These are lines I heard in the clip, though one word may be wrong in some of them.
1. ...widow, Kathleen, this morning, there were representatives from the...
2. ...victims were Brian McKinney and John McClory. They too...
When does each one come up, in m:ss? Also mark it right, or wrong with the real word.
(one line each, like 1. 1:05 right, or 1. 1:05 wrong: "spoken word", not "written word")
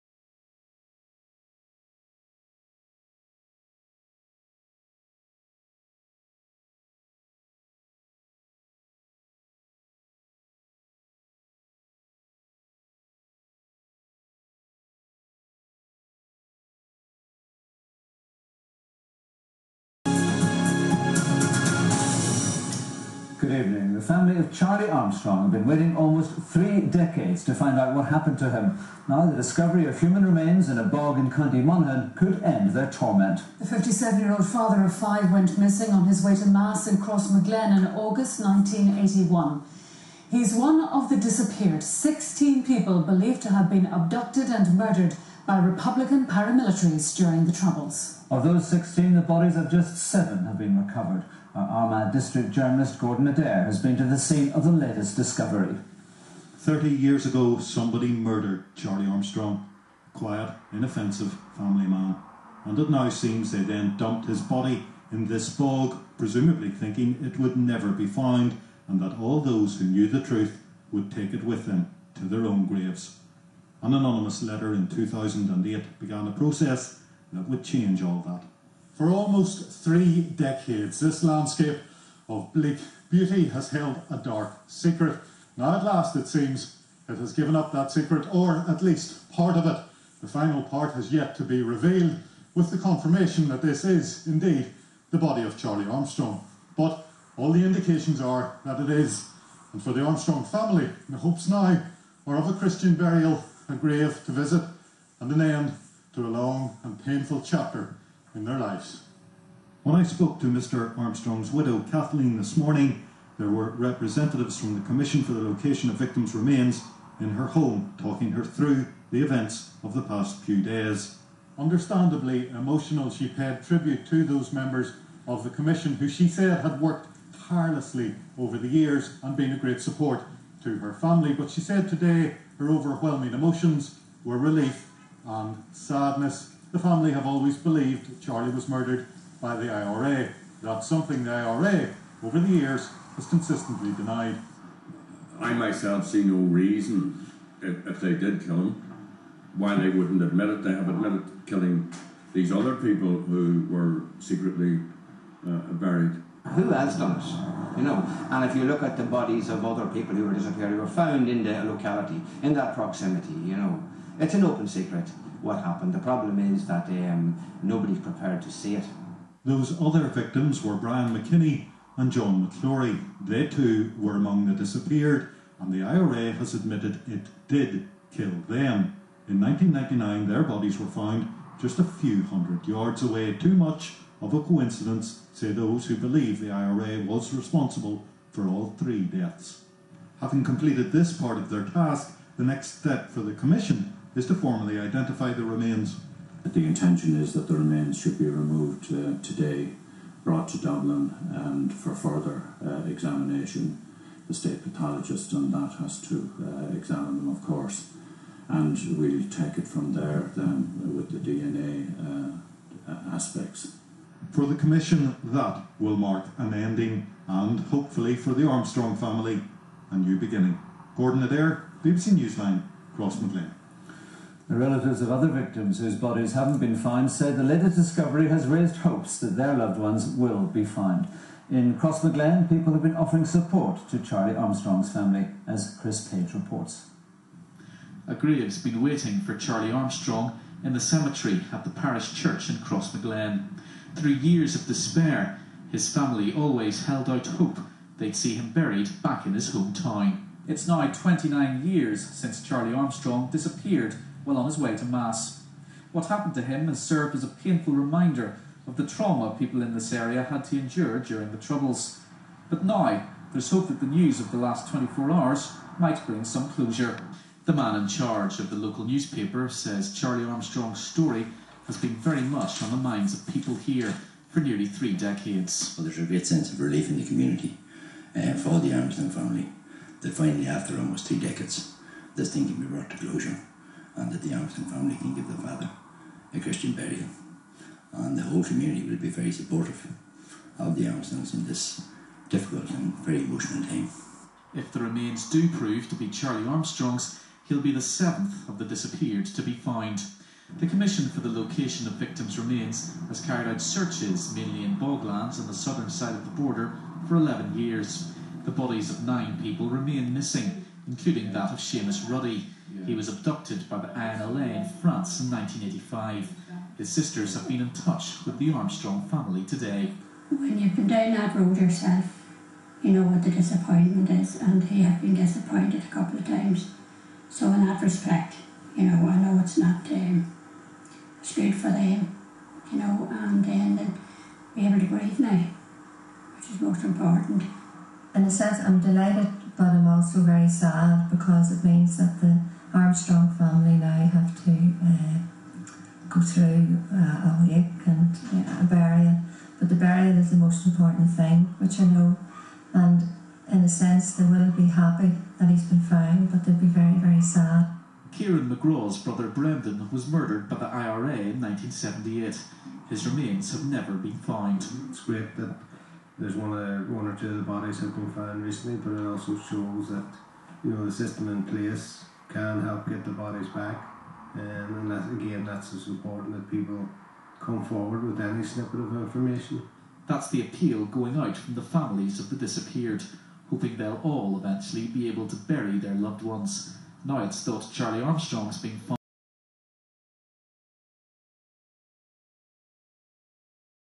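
1. 1:51 right
2. 2:50 right.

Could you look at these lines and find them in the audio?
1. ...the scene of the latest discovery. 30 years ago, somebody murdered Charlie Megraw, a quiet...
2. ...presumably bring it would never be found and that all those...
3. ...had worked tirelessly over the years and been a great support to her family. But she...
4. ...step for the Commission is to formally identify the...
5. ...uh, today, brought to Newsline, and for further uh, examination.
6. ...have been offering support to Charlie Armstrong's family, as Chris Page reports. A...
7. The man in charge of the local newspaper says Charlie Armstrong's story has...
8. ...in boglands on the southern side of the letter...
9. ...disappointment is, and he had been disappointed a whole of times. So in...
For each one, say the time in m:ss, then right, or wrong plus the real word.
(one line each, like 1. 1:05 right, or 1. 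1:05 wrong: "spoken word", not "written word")
1. 0:54 wrong: "Armstrong", not "Megraw"
2. 1:06 wrong: "thinking", not "bring"
3. 2:06 right
4. 3:12 right
5. 3:18 wrong: "Dublin", not "Newsline"
6. 3:52 right
7. 4:27 right
8. 5:04 wrong: "border", not "letter"
9. 5:23 wrong: "couple", not "whole".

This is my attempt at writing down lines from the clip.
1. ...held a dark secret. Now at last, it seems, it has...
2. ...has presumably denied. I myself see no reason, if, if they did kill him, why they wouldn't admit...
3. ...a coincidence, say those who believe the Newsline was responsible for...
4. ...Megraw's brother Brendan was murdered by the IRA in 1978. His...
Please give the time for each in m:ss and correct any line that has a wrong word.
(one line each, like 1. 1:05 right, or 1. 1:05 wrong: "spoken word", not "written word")
1. 1:23 right
2. 2:23 wrong: "consistently", not "presumably"
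3. 3:04 wrong: "IRA", not "Newsline"
4. 5:58 right.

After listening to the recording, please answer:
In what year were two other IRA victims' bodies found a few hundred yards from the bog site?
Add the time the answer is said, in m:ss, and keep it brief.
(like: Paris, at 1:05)
1999, at 2:59.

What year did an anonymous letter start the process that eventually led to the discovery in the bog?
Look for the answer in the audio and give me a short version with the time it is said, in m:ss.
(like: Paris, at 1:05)
2008, at 1:14.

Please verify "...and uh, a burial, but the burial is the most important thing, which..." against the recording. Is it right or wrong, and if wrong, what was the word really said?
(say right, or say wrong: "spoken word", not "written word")
right.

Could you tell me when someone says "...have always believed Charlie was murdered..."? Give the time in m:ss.
2:17.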